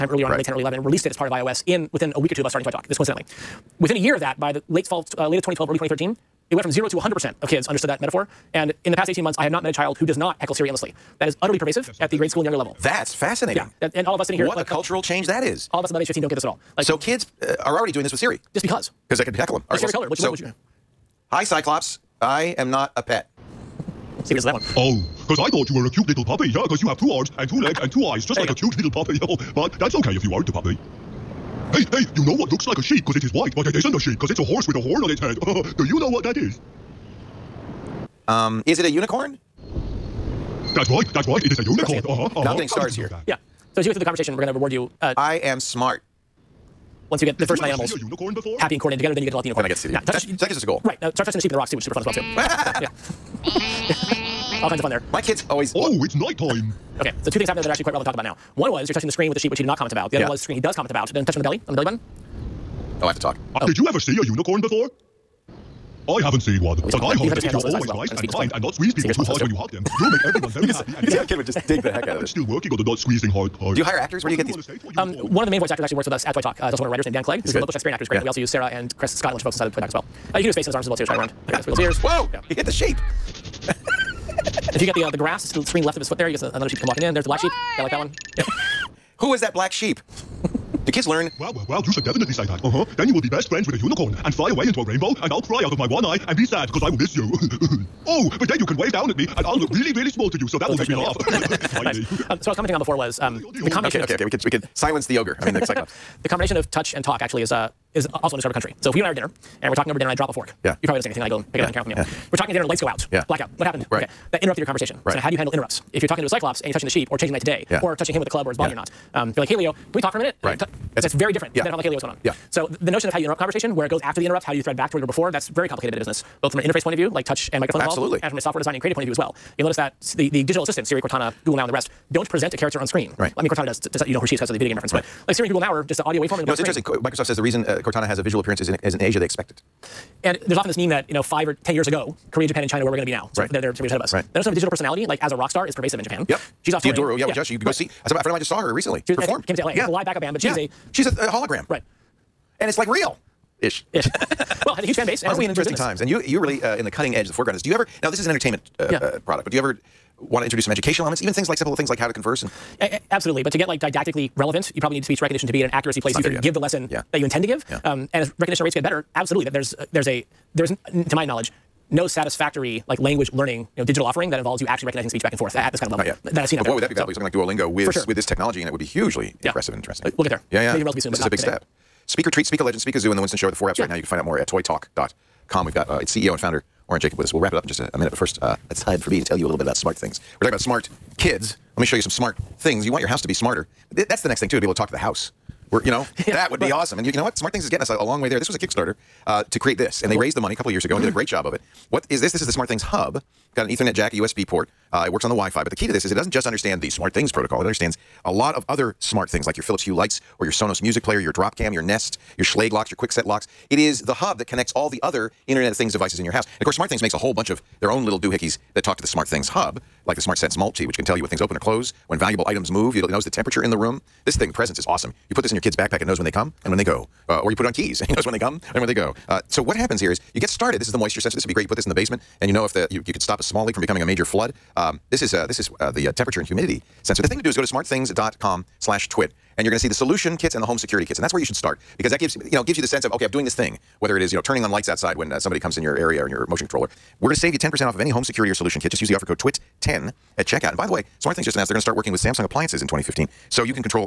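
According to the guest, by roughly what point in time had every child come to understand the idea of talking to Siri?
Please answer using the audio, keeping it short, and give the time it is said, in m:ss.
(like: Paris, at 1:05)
early 2013, at 0:05.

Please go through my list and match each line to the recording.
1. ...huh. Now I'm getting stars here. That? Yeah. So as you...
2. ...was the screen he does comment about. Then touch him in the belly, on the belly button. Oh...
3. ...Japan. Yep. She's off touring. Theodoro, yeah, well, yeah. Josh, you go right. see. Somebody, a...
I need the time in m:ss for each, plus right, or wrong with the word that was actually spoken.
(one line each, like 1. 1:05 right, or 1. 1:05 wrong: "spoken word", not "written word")
1. 0:42 right
2. 1:00 right
3. 2:26 right.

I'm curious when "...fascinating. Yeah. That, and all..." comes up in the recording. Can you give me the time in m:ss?
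0:13.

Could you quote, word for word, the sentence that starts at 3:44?
This thing, the presence, is awesome.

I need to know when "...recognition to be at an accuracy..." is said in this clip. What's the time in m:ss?
2:45.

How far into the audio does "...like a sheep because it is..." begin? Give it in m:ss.
0:32.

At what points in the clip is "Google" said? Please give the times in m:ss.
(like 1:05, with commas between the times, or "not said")
2:11, 2:15.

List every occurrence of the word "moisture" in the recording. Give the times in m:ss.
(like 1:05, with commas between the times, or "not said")
3:50.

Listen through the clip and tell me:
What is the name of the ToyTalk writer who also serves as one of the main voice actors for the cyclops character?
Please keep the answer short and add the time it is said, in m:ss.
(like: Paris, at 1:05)
Dan Clegg, at 1:17.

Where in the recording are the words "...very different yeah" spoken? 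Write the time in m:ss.
2:01.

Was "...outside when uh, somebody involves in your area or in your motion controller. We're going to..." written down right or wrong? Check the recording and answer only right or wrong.
wrong.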